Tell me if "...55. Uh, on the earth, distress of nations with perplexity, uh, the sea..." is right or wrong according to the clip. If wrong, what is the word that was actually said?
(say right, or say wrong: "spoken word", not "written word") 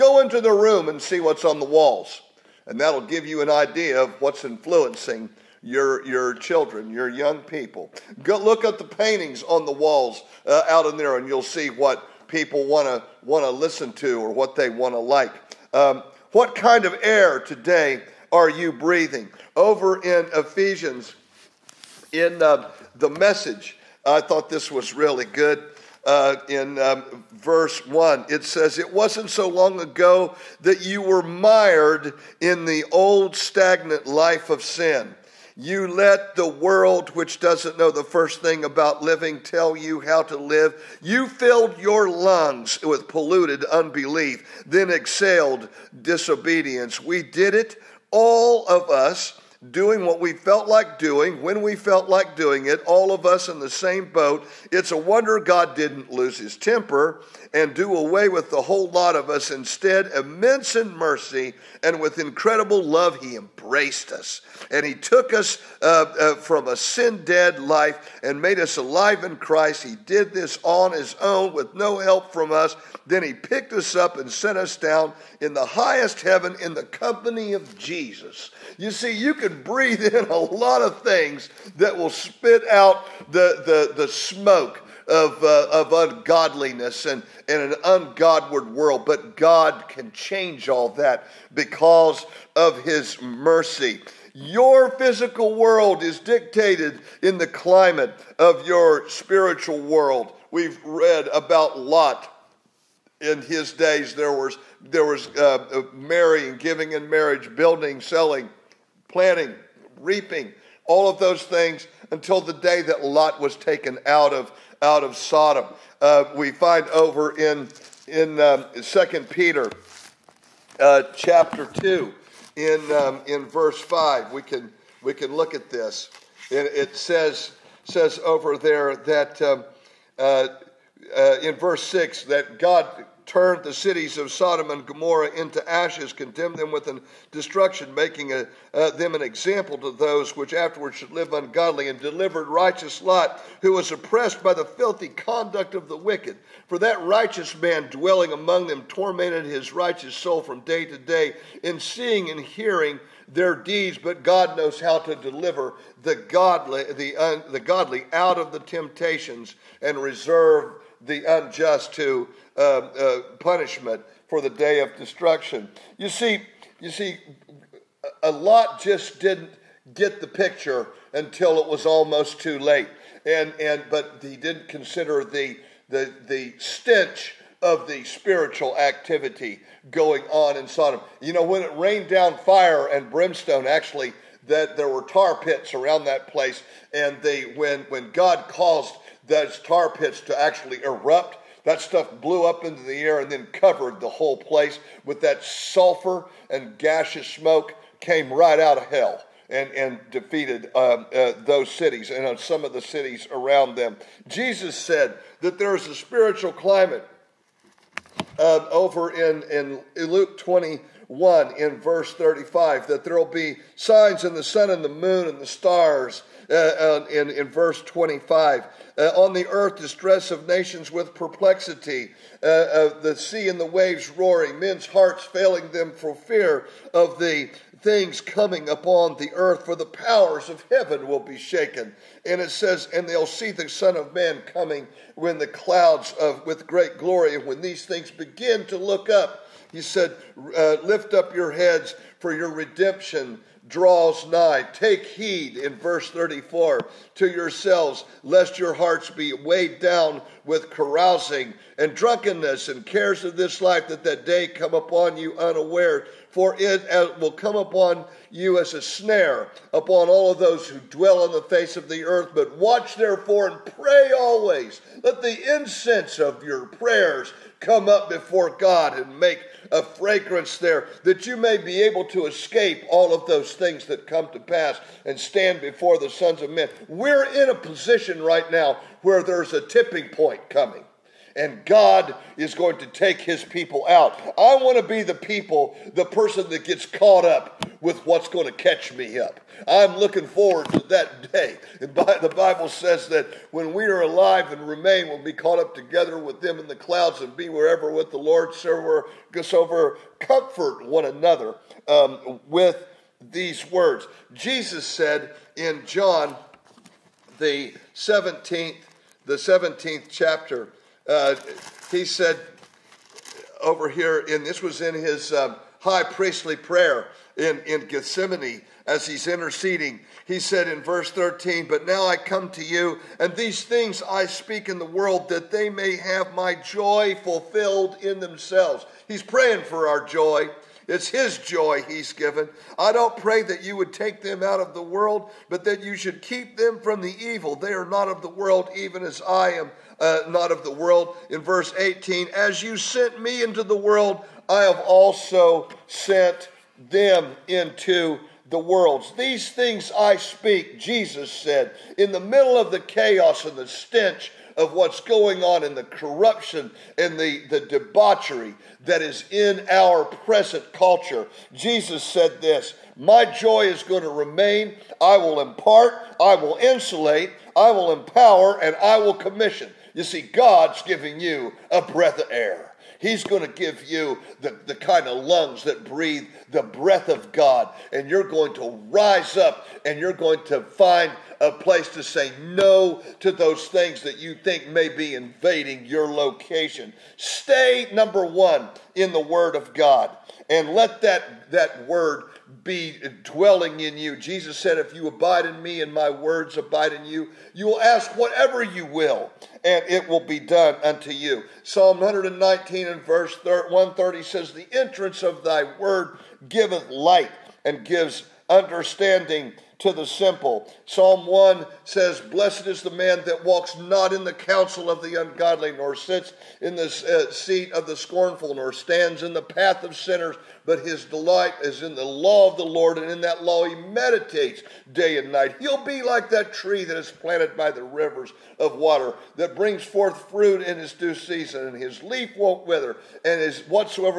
wrong: "25", not "55".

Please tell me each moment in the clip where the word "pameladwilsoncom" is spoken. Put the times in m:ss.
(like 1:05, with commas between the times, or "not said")
not said.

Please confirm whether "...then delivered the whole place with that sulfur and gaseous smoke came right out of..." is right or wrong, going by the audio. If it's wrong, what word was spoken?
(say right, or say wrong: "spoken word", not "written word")
wrong: "covered", not "delivered".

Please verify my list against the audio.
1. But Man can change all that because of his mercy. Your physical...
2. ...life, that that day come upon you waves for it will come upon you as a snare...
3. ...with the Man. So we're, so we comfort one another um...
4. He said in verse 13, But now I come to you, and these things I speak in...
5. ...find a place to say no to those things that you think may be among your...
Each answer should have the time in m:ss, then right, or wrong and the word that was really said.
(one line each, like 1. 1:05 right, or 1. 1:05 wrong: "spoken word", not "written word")
1. 1:29 wrong: "God", not "Man"
2. 4:13 wrong: "unawares", not "waves"
3. 4:57 wrong: "Lord", not "Man"
4. 5:20 right
5. 6:20 wrong: "invading", not "among".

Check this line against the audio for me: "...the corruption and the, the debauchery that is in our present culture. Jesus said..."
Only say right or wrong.
right.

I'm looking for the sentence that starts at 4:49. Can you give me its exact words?
I'm looking forward to that day.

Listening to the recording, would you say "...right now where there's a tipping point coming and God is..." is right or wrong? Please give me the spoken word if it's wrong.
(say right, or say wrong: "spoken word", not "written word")
right.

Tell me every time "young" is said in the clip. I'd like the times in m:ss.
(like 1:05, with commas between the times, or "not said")
0:07.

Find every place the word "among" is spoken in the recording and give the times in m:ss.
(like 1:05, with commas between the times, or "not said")
2:28.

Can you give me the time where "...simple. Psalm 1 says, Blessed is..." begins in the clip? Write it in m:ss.
6:50.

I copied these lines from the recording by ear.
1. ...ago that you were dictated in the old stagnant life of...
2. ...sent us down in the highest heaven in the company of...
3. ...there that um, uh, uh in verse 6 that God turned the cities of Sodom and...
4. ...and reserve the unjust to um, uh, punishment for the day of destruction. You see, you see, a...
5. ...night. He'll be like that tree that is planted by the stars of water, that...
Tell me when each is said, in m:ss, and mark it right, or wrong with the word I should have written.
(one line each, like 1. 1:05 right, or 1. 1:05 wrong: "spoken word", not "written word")
1. 0:29 wrong: "mired", not "dictated"
2. 1:14 right
3. 2:08 right
4. 2:39 right
5. 7:05 wrong: "rivers", not "stars".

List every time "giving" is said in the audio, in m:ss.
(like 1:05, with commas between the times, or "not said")
1:46, 6:10.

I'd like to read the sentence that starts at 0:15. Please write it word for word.
Um, what kind of air today are you breathing?